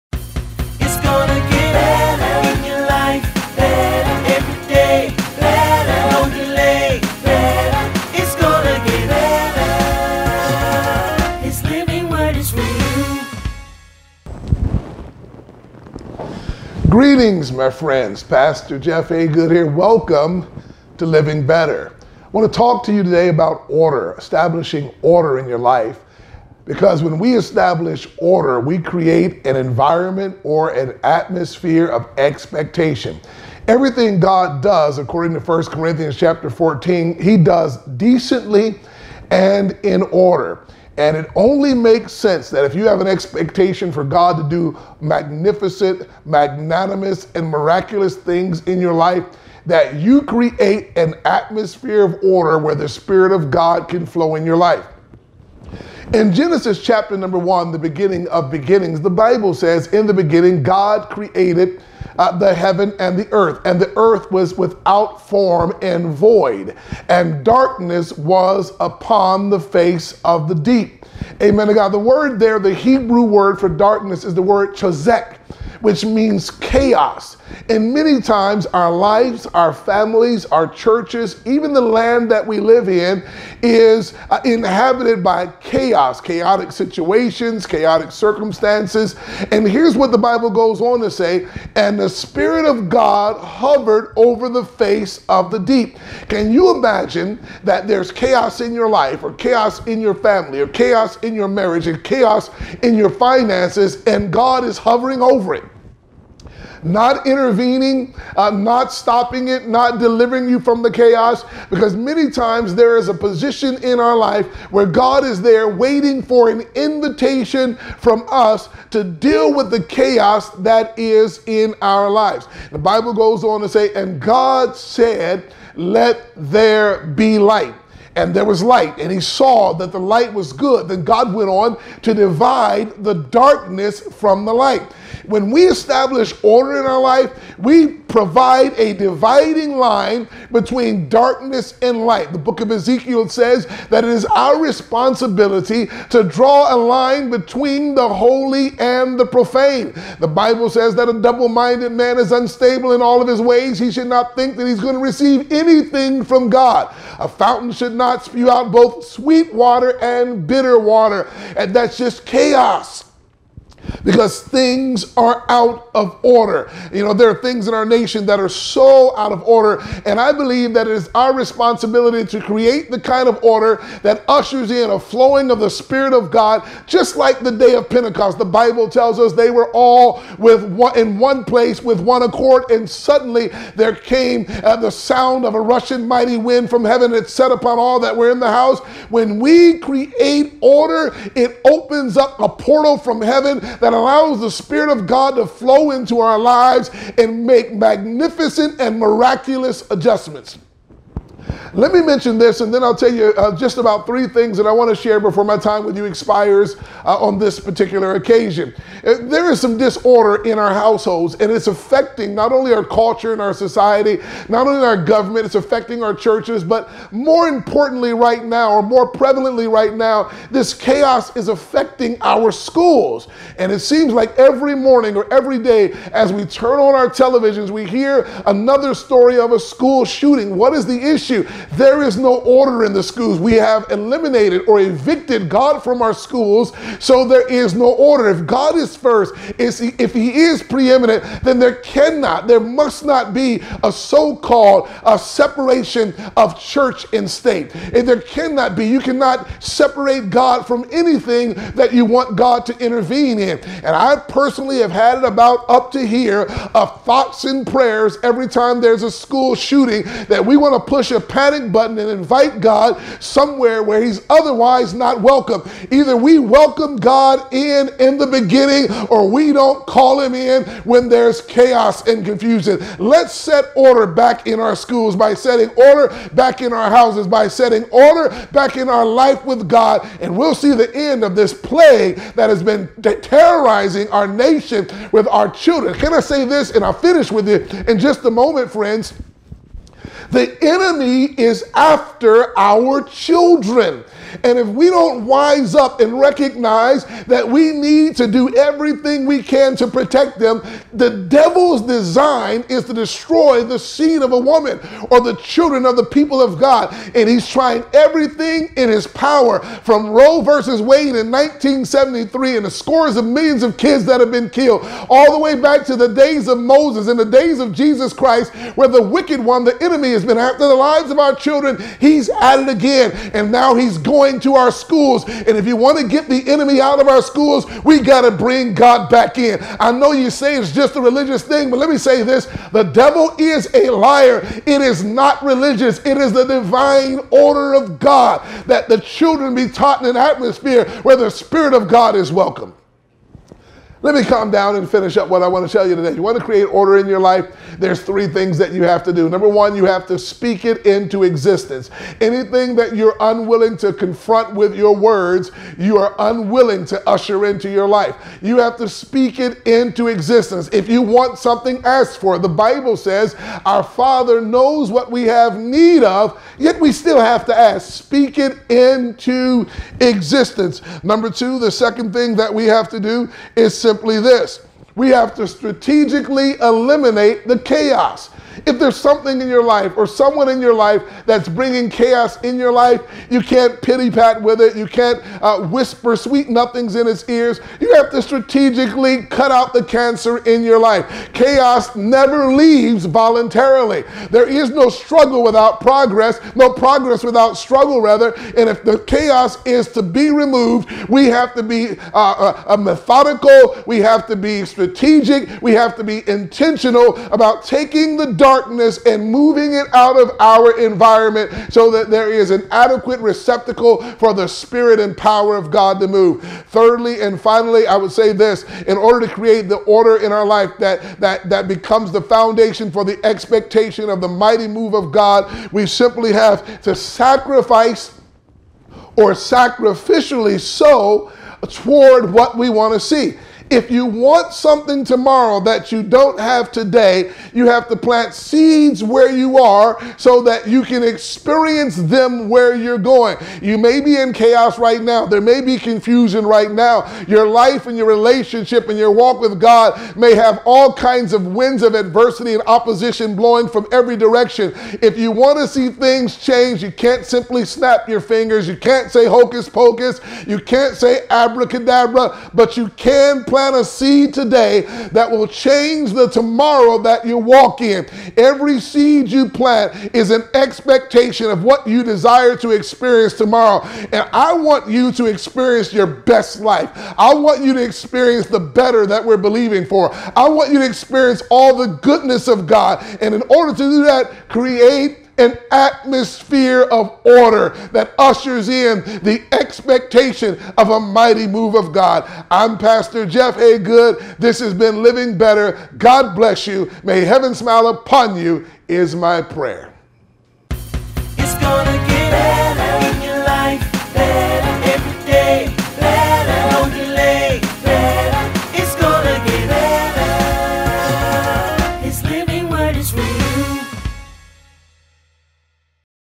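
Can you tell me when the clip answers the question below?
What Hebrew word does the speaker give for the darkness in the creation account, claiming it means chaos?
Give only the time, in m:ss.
1:14.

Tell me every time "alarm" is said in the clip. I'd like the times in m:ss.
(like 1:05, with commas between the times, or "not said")
not said.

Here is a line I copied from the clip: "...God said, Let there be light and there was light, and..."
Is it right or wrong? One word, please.
right.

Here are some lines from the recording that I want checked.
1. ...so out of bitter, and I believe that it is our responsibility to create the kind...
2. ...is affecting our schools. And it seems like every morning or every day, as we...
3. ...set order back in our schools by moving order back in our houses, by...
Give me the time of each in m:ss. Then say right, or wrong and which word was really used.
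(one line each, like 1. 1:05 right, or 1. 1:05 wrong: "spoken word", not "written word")
1. 2:48 wrong: "order", not "bitter"
2. 3:41 right
3. 4:33 wrong: "setting", not "moving".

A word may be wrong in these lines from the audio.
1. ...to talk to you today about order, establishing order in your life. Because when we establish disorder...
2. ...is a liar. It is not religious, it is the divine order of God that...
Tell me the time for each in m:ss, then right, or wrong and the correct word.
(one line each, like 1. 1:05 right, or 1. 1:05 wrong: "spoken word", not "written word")
1. 0:22 wrong: "order", not "disorder"
2. 5:33 right.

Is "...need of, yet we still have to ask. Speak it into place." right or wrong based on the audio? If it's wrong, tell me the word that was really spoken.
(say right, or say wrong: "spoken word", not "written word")
wrong: "existence", not "place".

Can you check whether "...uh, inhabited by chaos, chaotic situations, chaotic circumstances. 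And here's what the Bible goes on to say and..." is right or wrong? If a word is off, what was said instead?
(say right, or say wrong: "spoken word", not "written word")
right.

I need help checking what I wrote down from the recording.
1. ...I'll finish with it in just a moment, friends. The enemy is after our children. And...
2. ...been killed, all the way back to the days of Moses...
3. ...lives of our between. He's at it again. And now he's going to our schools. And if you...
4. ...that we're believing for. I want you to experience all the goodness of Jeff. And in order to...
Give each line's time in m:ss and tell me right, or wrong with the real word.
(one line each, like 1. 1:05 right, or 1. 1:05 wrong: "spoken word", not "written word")
1. 4:46 right
2. 5:14 right
3. 5:20 wrong: "children", not "between"
4. 7:59 wrong: "God", not "Jeff".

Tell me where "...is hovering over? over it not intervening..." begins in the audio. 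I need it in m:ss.
1:44.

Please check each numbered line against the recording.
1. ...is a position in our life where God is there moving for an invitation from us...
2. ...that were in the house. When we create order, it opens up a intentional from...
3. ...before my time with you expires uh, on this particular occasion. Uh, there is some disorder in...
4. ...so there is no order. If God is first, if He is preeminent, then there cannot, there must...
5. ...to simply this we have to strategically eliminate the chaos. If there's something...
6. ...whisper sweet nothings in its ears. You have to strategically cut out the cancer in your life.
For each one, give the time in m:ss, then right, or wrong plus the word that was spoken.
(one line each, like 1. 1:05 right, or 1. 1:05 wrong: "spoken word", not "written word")
1. 1:52 wrong: "waiting", not "moving"
2. 3:07 wrong: "portal", not "intentional"
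3. 3:25 right
4. 3:56 right
5. 6:13 right
6. 6:25 right.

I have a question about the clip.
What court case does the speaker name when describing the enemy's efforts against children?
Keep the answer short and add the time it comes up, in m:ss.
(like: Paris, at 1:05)
Roe versus Wade, at 5:10.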